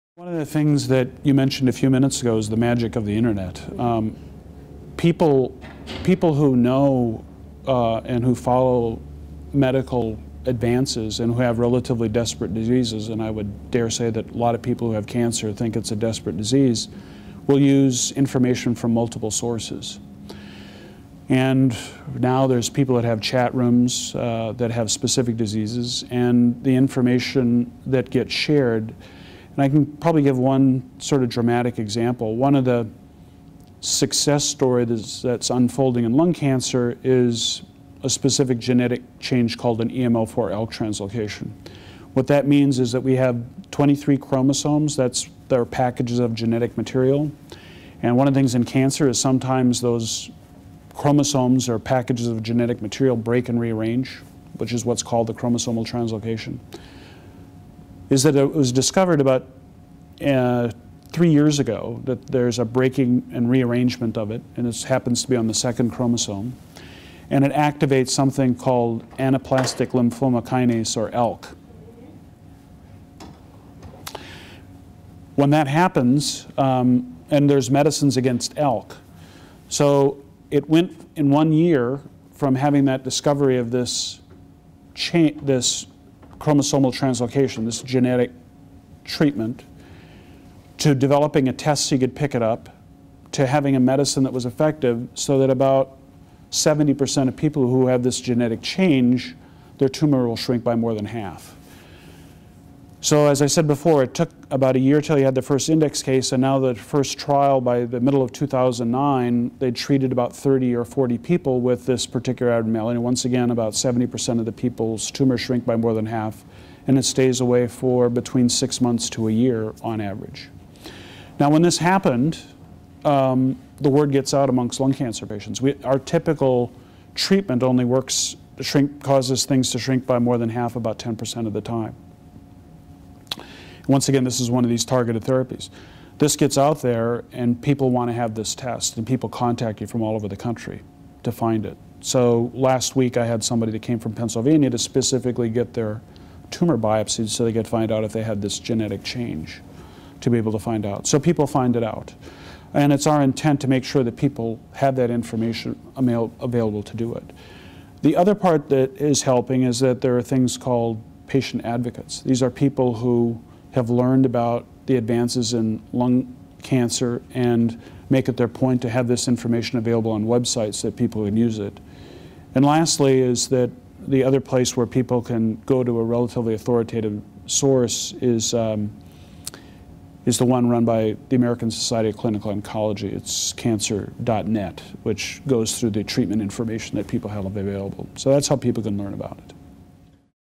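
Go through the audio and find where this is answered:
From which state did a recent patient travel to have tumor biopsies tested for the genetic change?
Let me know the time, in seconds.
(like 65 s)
144 s.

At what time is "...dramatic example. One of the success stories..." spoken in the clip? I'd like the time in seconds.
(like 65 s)
31 s.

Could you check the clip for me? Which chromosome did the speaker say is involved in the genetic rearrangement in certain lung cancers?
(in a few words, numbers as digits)
second.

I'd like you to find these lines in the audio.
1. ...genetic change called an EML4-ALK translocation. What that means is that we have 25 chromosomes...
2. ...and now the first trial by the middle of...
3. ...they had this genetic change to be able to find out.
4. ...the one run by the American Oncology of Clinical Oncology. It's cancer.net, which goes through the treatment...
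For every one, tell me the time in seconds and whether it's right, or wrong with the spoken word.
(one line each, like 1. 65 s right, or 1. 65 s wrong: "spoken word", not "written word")
1. 38 s wrong: "23", not "25"
2. 106 s right
3. 148 s right
4. 180 s wrong: "Society", not "Oncology".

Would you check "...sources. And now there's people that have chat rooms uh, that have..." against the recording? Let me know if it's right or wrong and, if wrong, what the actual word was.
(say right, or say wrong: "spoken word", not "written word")
right.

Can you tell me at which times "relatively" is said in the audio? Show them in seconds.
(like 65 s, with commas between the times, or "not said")
11 s, 176 s.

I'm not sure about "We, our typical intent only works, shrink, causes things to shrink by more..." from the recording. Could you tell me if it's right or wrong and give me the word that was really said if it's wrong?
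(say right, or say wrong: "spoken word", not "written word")
wrong: "treatment", not "intent".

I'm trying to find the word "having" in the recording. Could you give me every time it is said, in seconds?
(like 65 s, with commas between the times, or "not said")
82 s, 93 s.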